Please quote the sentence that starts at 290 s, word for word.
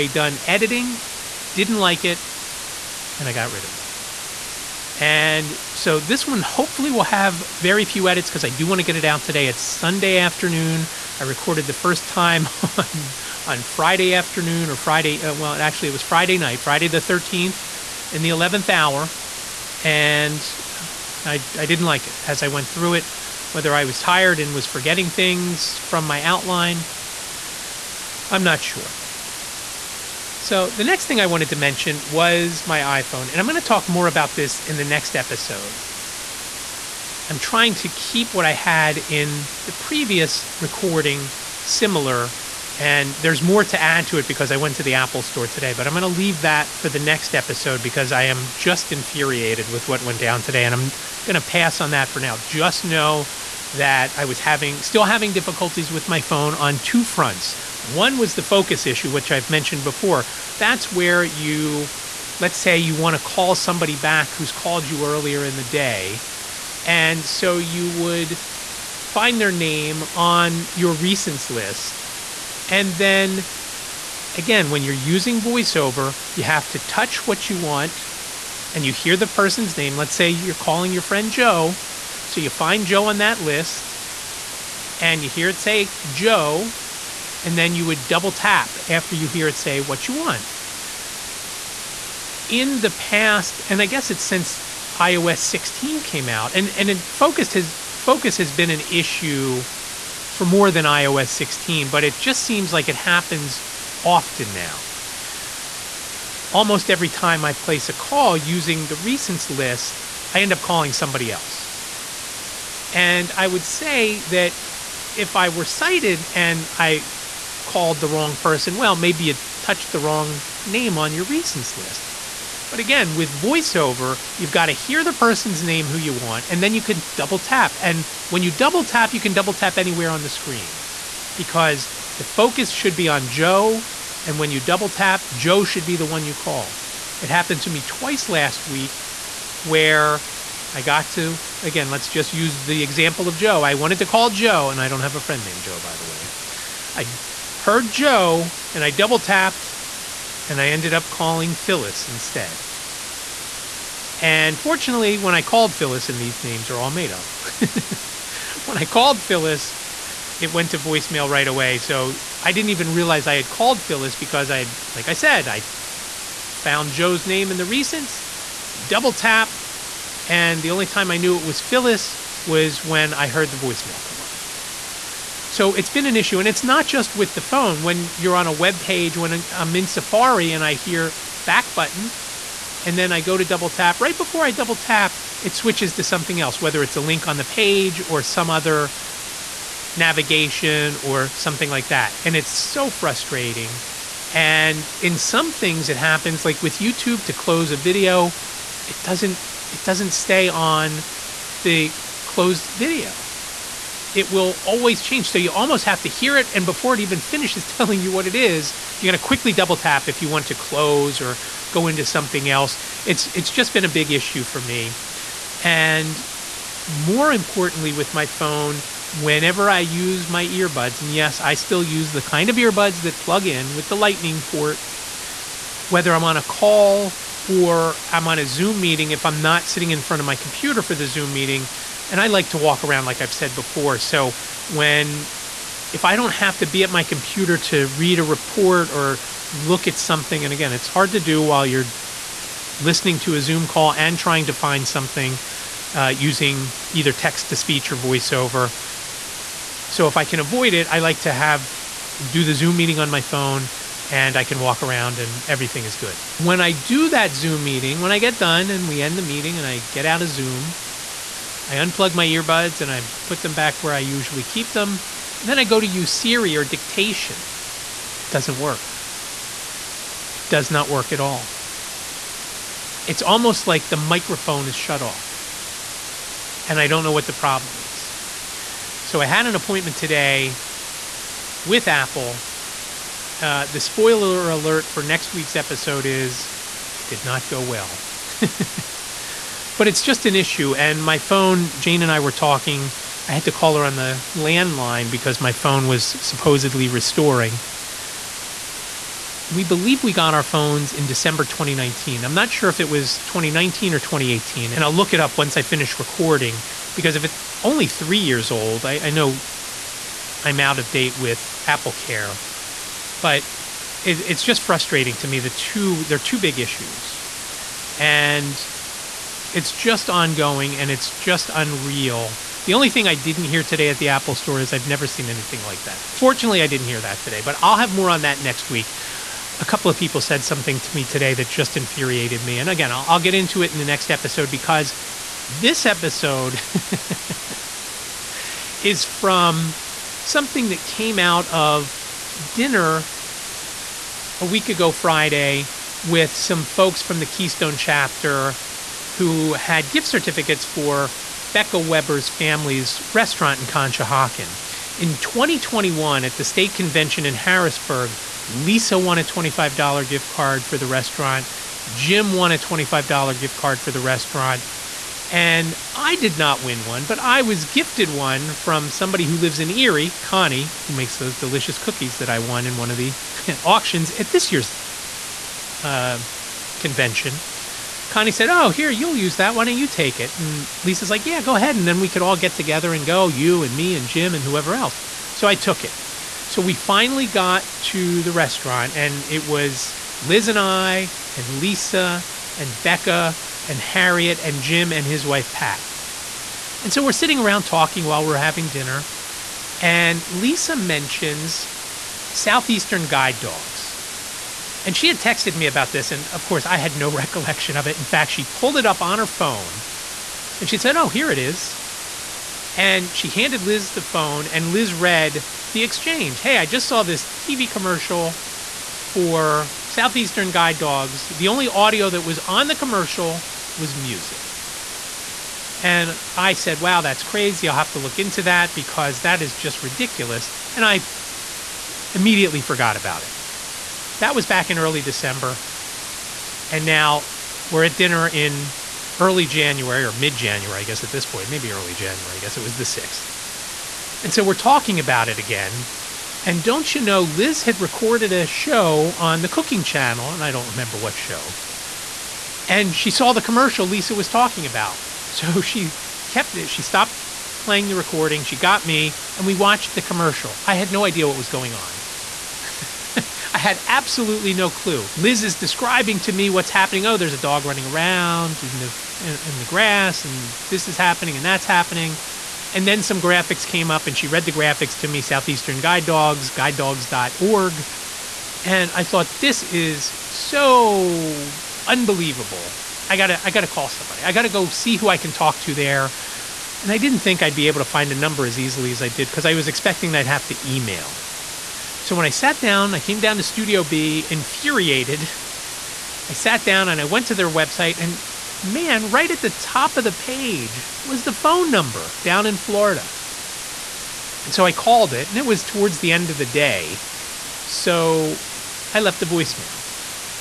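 And my phone, Jane and I were talking.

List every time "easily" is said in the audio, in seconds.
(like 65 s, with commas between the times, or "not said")
488 s.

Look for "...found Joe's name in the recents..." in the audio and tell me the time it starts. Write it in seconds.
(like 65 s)
166 s.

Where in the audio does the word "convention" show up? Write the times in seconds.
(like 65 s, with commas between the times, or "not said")
356 s, 376 s.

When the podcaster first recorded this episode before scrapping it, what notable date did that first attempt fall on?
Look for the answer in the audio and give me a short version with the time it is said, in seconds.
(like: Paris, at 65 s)
Friday the 13th, at 16 s.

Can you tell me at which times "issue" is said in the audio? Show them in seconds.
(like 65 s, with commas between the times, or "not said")
58 s, 98 s, 176 s, 214 s, 290 s, 316 s.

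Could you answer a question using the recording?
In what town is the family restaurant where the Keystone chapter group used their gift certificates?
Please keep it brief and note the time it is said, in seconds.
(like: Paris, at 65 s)
Conshohocken, at 353 s.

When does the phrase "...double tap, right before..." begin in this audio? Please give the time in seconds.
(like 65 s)
183 s.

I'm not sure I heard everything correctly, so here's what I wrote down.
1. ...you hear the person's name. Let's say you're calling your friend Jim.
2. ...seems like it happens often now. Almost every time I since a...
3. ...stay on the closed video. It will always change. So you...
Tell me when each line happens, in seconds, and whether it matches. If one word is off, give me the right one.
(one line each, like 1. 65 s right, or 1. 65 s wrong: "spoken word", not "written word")
1. 78 s wrong: "Joe", not "Jim"
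2. 102 s wrong: "place", not "since"
3. 200 s right.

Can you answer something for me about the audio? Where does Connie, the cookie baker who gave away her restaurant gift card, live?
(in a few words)
Erie.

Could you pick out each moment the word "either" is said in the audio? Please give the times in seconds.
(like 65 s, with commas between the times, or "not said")
246 s.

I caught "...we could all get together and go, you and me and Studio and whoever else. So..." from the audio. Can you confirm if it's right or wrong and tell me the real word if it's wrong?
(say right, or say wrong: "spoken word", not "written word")
wrong: "Jim", not "Studio".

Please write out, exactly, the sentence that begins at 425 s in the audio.
And I said, wow, that's crazy.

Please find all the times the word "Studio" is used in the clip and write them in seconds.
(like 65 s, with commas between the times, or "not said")
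493 s.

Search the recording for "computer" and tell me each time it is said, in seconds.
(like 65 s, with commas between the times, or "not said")
230 s, 237 s.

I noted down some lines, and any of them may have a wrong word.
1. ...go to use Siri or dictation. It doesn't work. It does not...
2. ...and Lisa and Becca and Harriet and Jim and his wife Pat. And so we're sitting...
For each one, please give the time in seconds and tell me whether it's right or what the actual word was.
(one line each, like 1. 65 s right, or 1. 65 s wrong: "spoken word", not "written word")
1. 265 s right
2. 391 s right.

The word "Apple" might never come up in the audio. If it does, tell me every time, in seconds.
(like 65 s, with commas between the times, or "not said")
44 s, 281 s, 311 s, 324 s.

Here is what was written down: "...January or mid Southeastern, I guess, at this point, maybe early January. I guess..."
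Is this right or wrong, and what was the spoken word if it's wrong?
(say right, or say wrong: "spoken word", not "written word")
wrong: "January", not "Southeastern".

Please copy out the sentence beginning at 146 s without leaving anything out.
I heard Joe, and I double tapped, and I ended up calling Phyllis instead.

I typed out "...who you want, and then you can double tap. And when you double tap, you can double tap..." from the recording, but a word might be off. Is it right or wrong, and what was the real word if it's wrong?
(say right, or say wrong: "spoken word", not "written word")
right.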